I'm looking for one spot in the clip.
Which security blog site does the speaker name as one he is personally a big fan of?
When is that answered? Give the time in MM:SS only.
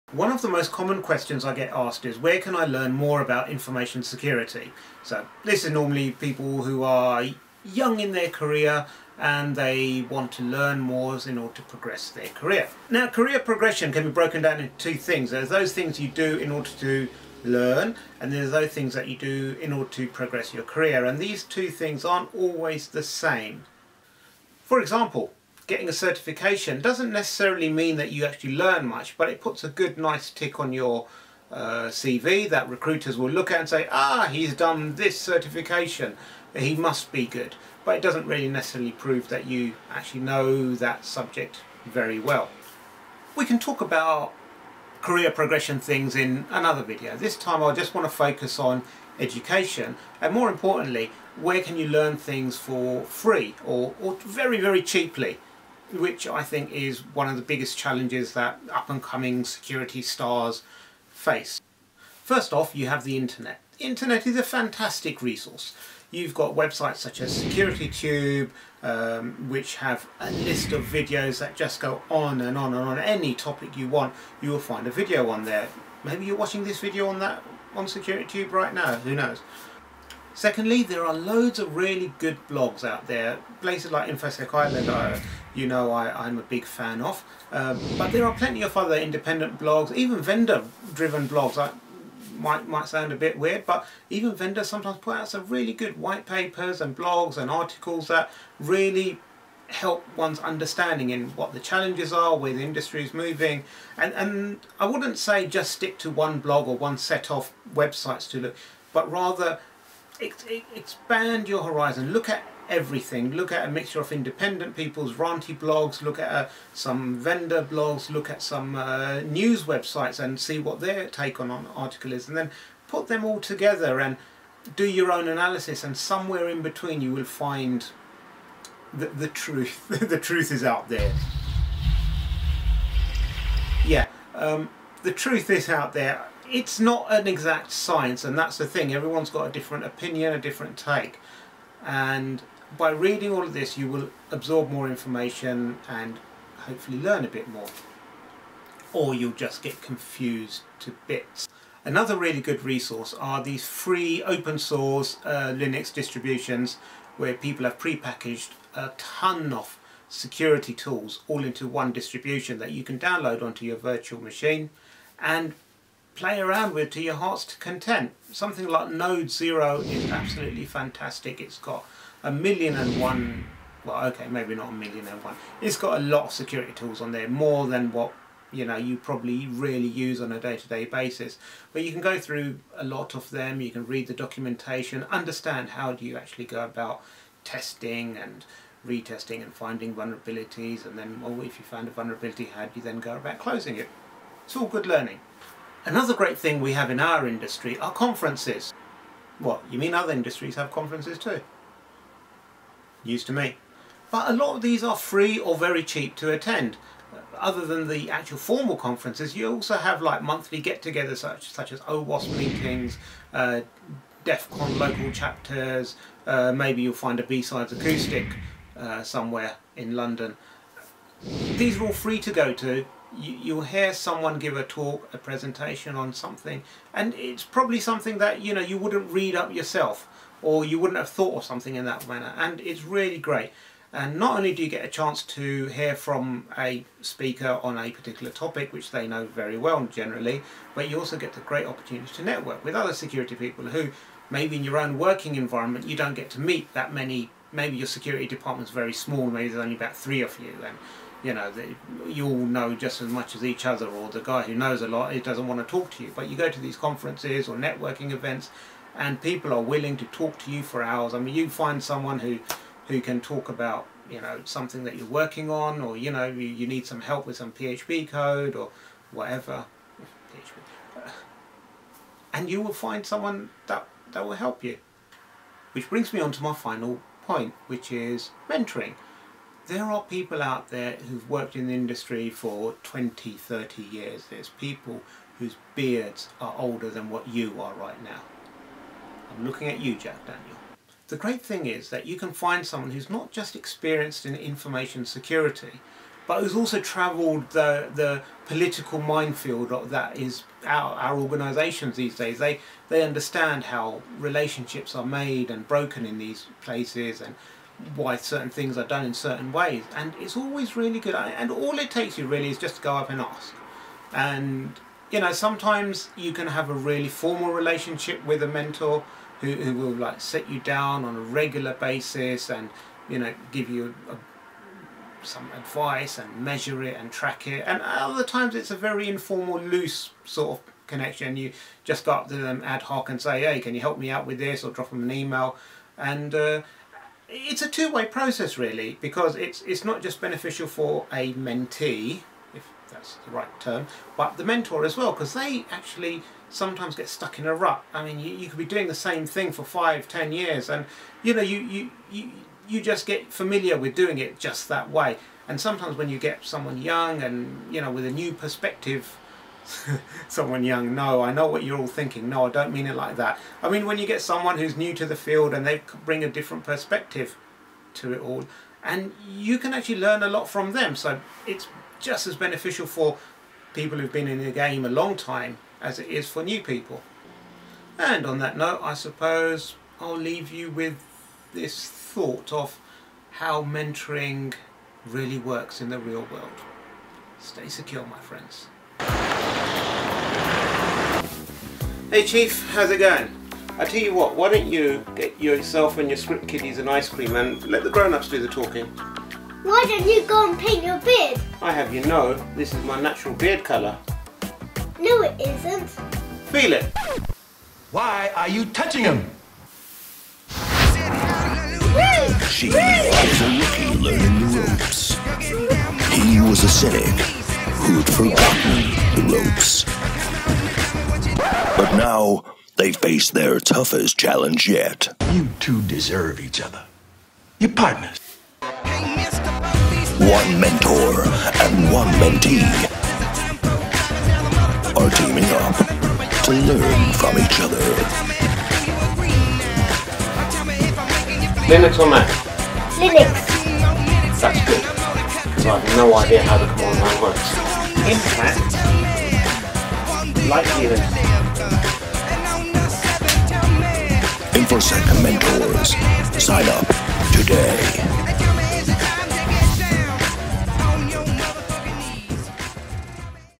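01:24.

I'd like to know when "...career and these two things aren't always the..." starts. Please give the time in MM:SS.
00:20.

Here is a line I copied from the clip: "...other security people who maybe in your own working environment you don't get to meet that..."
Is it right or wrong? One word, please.
right.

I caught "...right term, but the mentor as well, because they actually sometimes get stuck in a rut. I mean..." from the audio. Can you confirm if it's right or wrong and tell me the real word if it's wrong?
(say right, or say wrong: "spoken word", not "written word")
right.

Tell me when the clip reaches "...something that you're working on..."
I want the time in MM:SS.
04:24.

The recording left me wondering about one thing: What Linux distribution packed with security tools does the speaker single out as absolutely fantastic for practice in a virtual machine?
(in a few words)
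Node Zero.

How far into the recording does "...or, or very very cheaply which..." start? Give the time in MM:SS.
00:53.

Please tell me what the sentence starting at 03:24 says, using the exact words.
But a lot of these are free or very cheap to attend.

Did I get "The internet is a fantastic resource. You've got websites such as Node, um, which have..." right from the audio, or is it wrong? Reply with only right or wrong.
wrong.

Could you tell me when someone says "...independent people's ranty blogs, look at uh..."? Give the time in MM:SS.
01:54.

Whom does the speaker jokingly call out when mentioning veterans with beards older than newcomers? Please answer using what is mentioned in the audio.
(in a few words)
Jack Daniel.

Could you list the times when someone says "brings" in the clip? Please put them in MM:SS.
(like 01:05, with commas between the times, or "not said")
04:35, 06:06.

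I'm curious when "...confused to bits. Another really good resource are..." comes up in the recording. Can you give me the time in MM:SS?
02:29.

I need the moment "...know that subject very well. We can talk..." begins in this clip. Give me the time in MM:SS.
00:40.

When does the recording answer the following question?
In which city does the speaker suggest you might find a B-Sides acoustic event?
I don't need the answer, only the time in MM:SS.
03:39.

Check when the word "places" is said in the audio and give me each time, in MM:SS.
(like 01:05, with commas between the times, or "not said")
01:23, 05:06.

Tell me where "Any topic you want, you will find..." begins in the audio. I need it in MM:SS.
01:12.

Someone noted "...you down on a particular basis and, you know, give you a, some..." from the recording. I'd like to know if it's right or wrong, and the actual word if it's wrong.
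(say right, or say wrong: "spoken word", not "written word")
wrong: "regular", not "particular".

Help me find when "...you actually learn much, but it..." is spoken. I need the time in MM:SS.
00:28.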